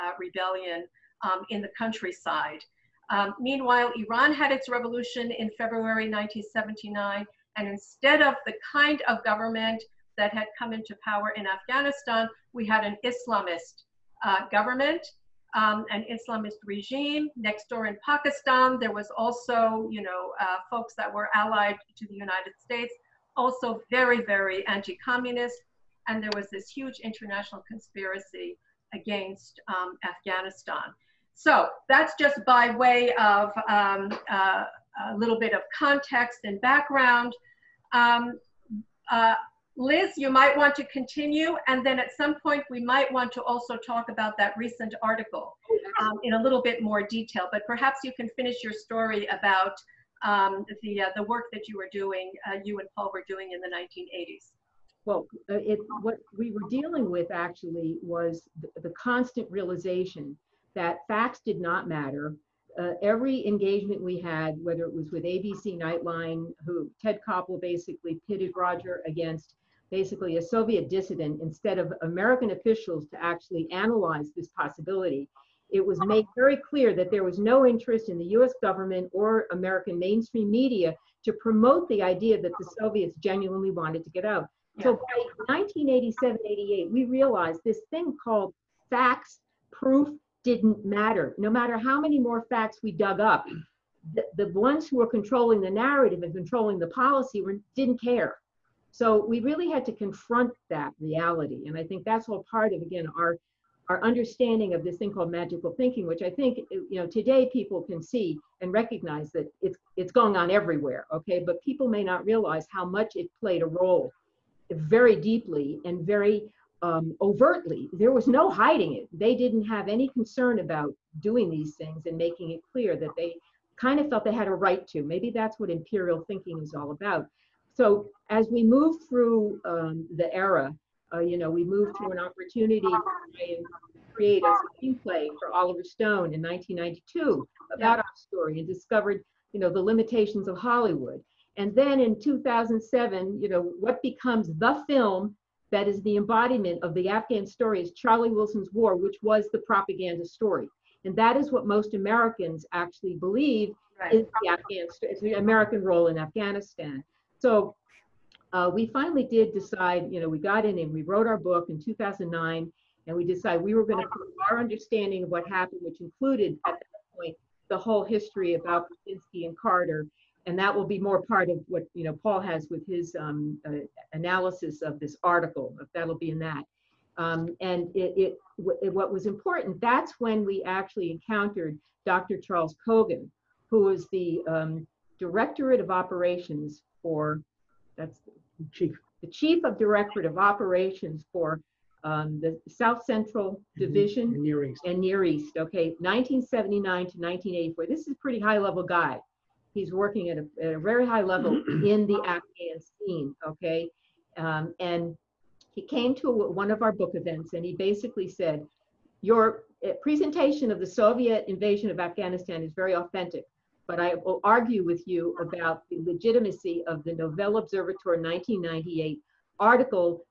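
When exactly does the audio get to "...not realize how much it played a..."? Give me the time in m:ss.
1:52.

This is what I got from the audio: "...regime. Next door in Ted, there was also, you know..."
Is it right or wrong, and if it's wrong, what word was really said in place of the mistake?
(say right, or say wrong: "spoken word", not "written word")
wrong: "Pakistan", not "Ted".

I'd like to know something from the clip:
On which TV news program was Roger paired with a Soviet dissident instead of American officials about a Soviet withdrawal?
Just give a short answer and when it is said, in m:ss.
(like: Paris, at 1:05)
ABC Nightline, at 1:05.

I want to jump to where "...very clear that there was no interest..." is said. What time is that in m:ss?
1:16.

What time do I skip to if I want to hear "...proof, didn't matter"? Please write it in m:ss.
1:29.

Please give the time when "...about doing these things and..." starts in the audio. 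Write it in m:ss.
2:00.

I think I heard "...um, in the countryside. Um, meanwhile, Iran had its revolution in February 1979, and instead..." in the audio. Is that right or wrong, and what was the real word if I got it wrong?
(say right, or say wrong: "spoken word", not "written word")
right.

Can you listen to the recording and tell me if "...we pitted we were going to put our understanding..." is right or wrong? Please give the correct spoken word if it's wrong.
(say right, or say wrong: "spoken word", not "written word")
wrong: "decided", not "pitted".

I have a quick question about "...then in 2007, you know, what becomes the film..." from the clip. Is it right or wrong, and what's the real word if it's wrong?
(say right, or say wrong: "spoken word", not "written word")
right.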